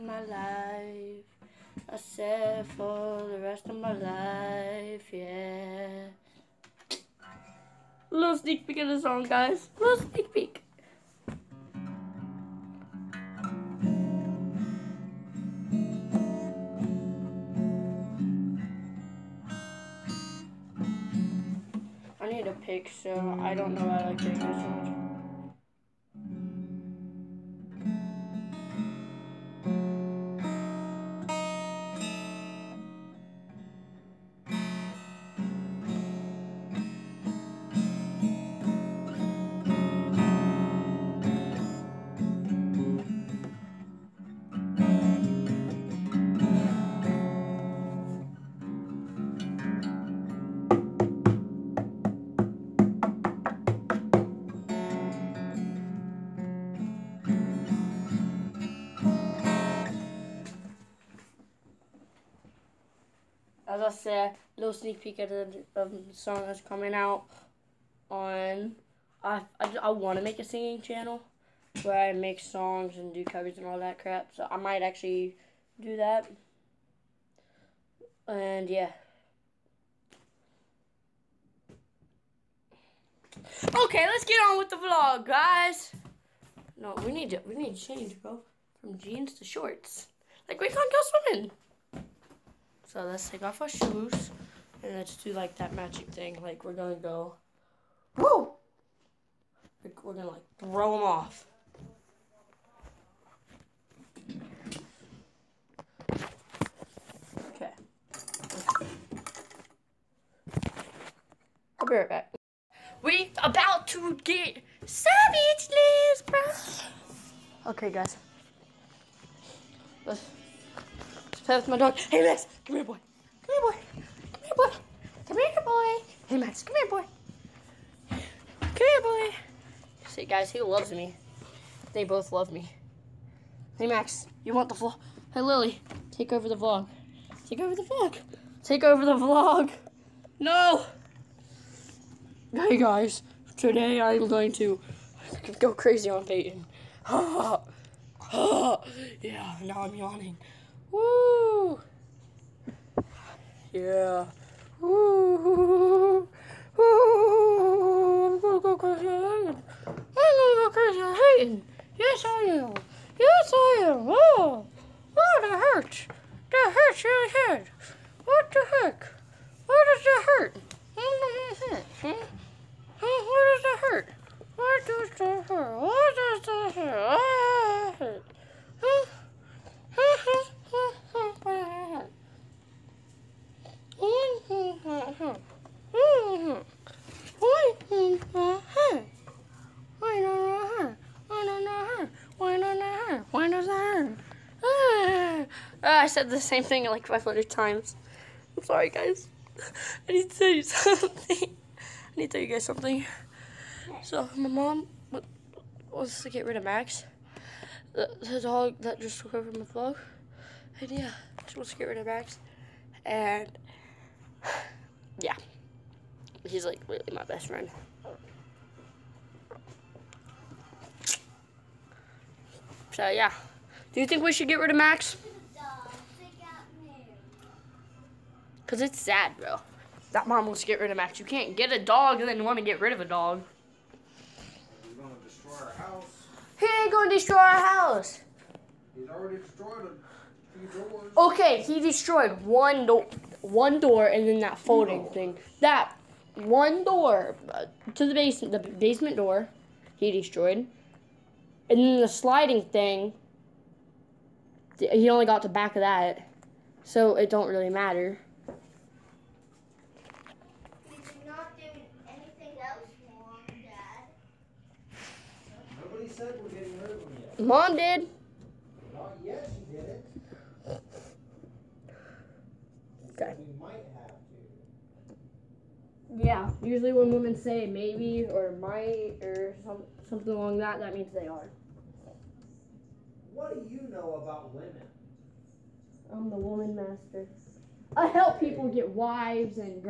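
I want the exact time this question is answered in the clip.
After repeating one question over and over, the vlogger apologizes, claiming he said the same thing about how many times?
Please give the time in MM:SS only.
03:17.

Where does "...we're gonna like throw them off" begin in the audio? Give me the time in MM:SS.
01:40.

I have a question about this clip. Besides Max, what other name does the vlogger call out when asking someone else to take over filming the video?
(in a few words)
Lily.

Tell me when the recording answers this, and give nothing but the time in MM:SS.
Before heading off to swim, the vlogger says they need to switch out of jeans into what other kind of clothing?
01:29.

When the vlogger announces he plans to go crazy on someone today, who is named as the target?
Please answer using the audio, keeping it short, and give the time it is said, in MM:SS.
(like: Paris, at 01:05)
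Peyton, at 02:26.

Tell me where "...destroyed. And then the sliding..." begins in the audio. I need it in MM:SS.
04:10.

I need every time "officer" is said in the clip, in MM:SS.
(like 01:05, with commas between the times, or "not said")
not said.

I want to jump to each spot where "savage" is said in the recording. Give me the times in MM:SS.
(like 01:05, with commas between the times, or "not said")
01:54.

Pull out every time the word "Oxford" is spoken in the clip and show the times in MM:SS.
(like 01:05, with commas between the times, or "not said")
not said.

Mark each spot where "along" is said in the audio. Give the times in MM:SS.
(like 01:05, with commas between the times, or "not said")
04:40.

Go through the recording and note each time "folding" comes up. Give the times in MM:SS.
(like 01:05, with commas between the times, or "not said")
04:04.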